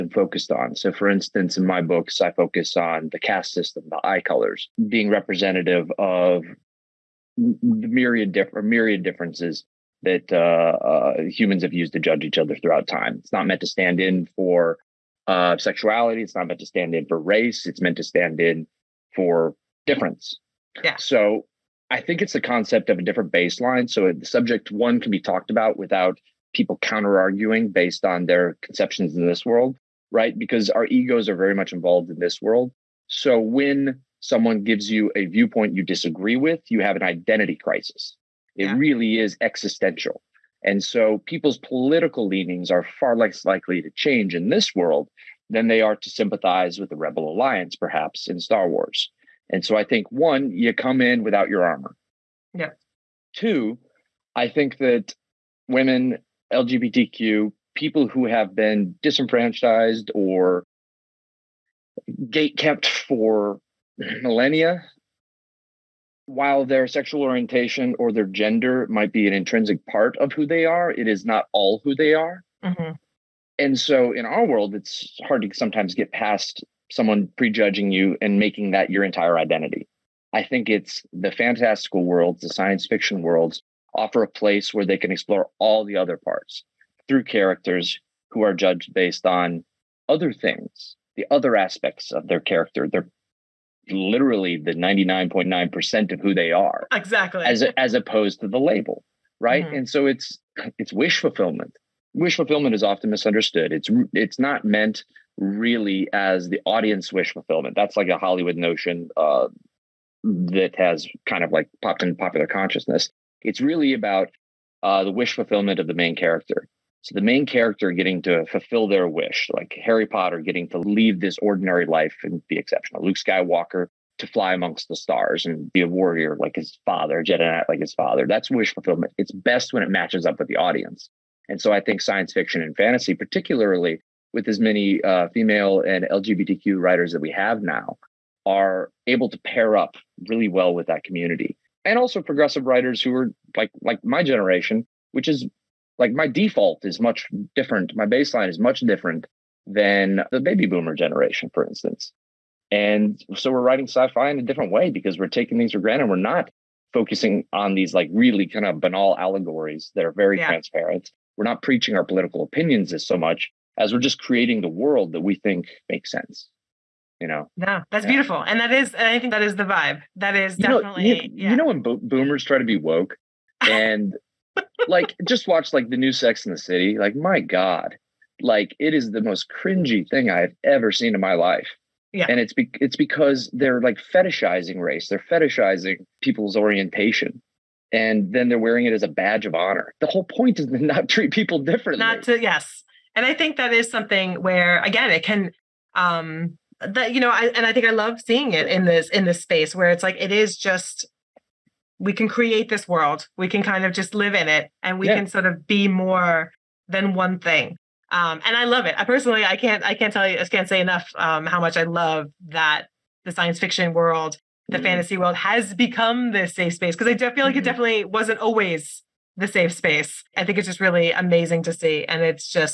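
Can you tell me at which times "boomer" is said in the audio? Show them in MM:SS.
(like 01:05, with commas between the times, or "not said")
02:30, 02:52.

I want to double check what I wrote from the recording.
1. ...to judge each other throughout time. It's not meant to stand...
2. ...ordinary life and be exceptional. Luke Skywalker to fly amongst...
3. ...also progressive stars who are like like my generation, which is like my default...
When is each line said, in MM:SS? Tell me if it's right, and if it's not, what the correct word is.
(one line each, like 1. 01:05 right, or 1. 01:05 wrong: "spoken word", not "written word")
1. 00:11 right
2. 02:01 right
3. 02:21 wrong: "writers", not "stars".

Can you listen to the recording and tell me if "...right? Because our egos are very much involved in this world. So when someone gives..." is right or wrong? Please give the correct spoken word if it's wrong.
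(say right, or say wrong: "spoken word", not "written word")
right.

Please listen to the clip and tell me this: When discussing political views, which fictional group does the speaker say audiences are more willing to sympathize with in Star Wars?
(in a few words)
Rebel Alliance.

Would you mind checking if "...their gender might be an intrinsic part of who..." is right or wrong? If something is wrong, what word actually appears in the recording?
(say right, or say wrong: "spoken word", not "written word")
right.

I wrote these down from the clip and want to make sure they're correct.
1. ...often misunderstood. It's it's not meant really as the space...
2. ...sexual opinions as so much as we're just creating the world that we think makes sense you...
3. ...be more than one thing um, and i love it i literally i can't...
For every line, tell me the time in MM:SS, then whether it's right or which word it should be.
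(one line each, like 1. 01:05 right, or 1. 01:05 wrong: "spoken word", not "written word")
1. 01:42 wrong: "audience", not "space"
2. 02:42 wrong: "political", not "sexual"
3. 03:25 wrong: "personally", not "literally".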